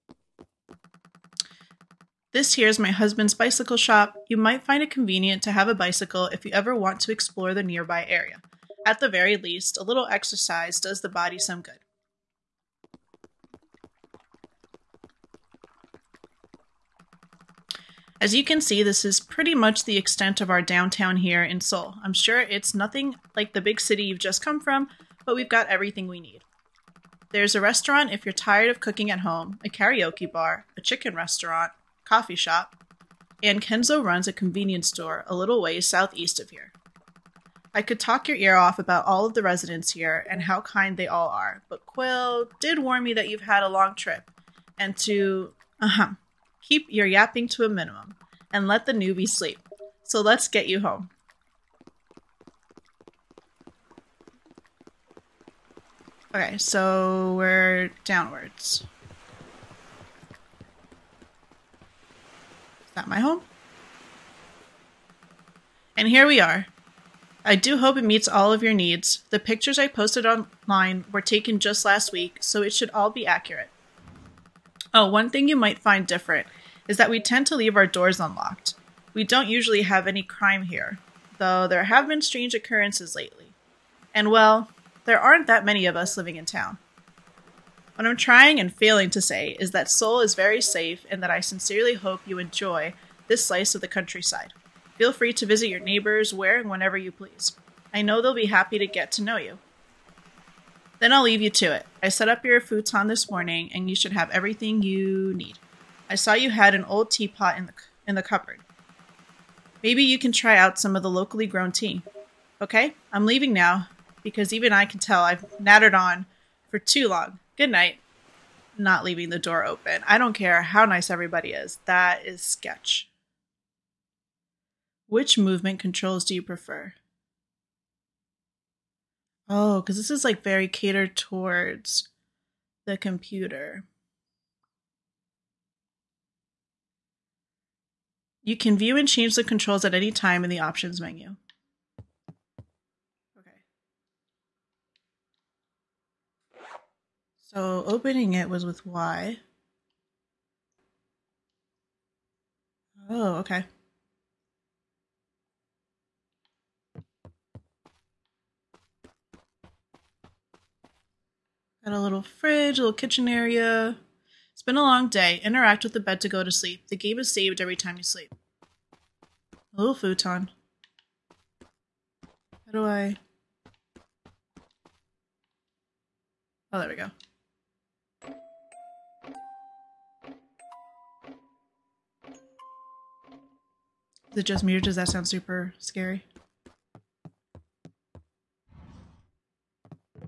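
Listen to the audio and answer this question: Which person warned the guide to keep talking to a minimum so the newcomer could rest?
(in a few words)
Quill.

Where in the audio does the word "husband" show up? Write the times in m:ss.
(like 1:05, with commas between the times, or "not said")
0:02.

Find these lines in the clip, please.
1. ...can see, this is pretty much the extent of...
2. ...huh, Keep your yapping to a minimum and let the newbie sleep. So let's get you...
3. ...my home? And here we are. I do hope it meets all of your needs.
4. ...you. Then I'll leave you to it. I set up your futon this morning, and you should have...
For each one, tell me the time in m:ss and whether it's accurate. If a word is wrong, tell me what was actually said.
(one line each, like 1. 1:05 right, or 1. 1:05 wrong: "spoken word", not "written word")
1. 0:18 right
2. 0:45 right
3. 1:03 right
4. 1:39 right.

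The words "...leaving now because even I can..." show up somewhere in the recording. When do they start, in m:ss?
1:53.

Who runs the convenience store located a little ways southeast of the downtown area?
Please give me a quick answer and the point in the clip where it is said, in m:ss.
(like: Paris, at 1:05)
Kenzo, at 0:33.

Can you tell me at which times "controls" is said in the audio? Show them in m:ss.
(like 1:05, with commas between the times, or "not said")
2:05, 2:19.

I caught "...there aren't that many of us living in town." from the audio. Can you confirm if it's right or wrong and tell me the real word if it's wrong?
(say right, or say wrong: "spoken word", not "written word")
right.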